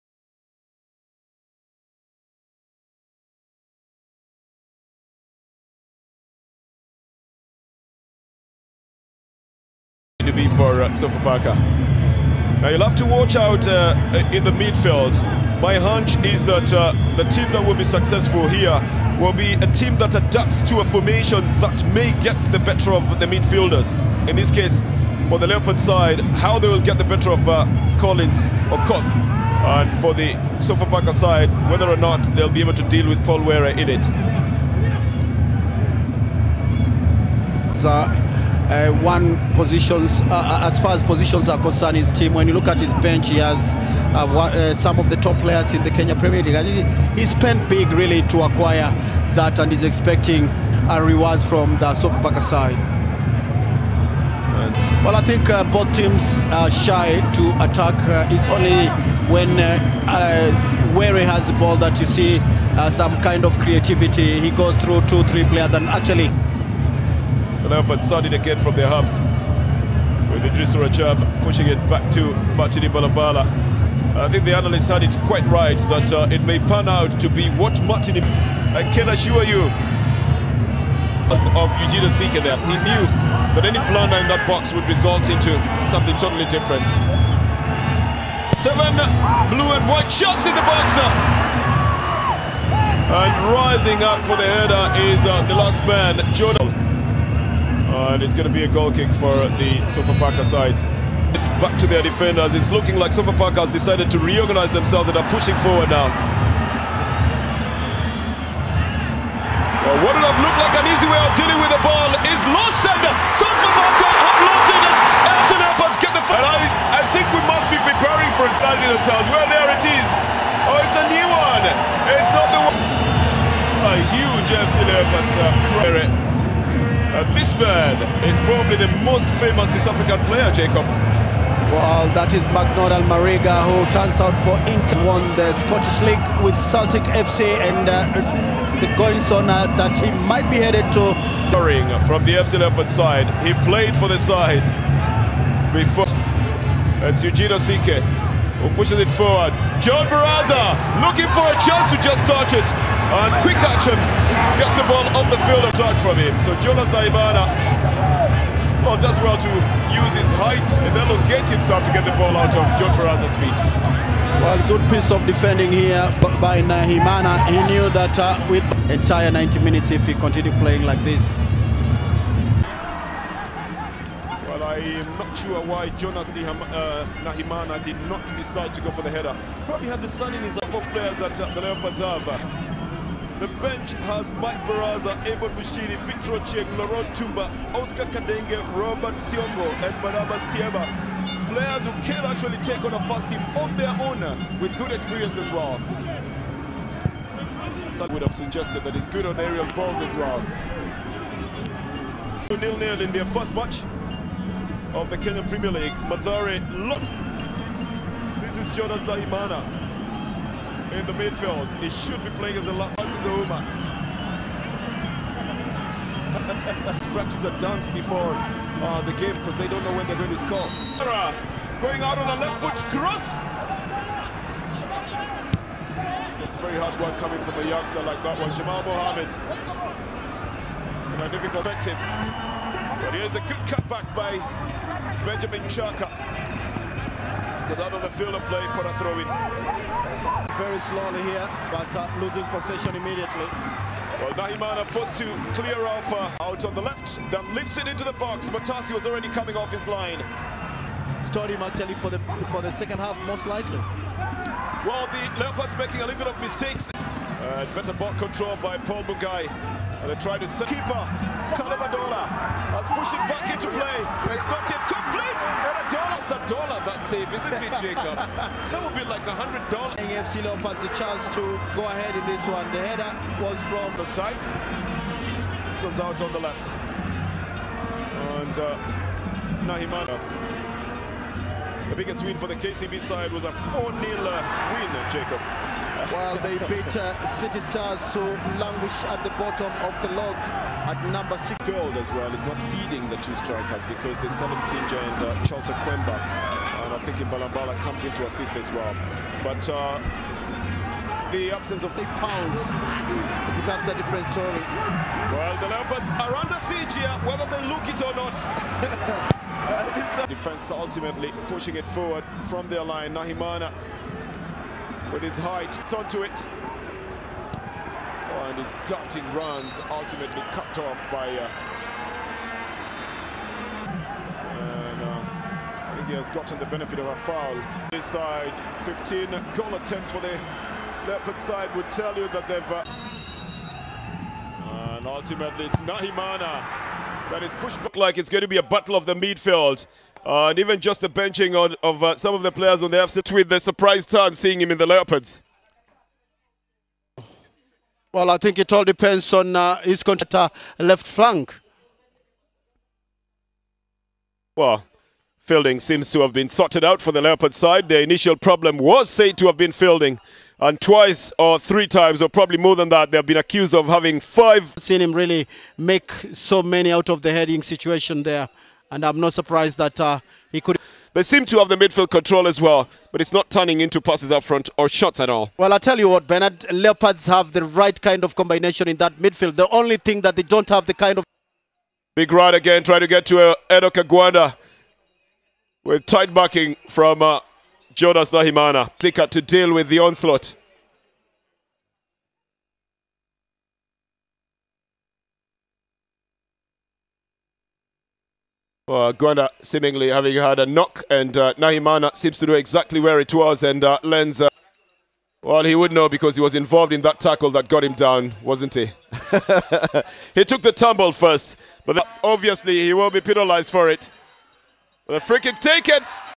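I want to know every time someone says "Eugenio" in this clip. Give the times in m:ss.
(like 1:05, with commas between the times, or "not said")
1:21, 2:27.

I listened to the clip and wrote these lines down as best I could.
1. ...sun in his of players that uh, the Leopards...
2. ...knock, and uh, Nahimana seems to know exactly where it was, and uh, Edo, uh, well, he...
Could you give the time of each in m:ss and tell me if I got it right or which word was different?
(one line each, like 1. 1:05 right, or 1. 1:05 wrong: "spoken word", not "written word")
1. 3:00 right
2. 6:40 wrong: "Lenz", not "Edo".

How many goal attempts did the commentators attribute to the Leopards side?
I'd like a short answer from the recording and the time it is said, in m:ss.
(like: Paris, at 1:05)
15, at 5:28.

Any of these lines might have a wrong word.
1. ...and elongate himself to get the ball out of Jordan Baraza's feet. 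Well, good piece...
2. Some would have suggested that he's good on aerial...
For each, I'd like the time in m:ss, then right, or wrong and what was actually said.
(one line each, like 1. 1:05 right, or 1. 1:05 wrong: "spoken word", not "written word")
1. 2:40 wrong: "John", not "Jordan"
2. 3:17 right.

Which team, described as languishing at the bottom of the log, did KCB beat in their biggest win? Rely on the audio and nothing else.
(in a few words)
City Stars.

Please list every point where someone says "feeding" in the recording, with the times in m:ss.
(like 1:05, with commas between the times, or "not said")
4:52.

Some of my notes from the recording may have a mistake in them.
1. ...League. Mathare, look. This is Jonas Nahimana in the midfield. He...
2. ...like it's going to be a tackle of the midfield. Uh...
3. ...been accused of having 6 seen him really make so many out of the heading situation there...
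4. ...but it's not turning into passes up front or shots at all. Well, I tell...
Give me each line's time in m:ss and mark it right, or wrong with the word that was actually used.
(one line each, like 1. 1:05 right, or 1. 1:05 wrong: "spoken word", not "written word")
1. 3:25 right
2. 5:37 wrong: "battle", not "tackle"
3. 6:03 wrong: "5", not "6"
4. 6:13 right.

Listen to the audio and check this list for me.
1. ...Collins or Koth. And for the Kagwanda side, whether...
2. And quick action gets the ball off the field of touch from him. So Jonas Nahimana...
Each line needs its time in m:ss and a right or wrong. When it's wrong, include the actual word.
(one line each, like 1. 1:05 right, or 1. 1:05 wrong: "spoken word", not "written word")
1. 0:27 wrong: "Sofapaka", not "Kagwanda"
2. 2:33 right.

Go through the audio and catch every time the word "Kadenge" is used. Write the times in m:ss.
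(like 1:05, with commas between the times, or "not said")
3:08.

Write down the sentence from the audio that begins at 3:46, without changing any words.
It's very hard work coming from a youngster like that one, Jamal Mohamed.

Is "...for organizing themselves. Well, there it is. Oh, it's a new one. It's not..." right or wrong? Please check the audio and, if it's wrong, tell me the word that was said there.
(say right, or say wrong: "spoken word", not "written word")
right.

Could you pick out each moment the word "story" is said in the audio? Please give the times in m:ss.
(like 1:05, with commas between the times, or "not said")
4:11, 5:04.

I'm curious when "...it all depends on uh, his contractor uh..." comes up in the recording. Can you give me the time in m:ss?
5:48.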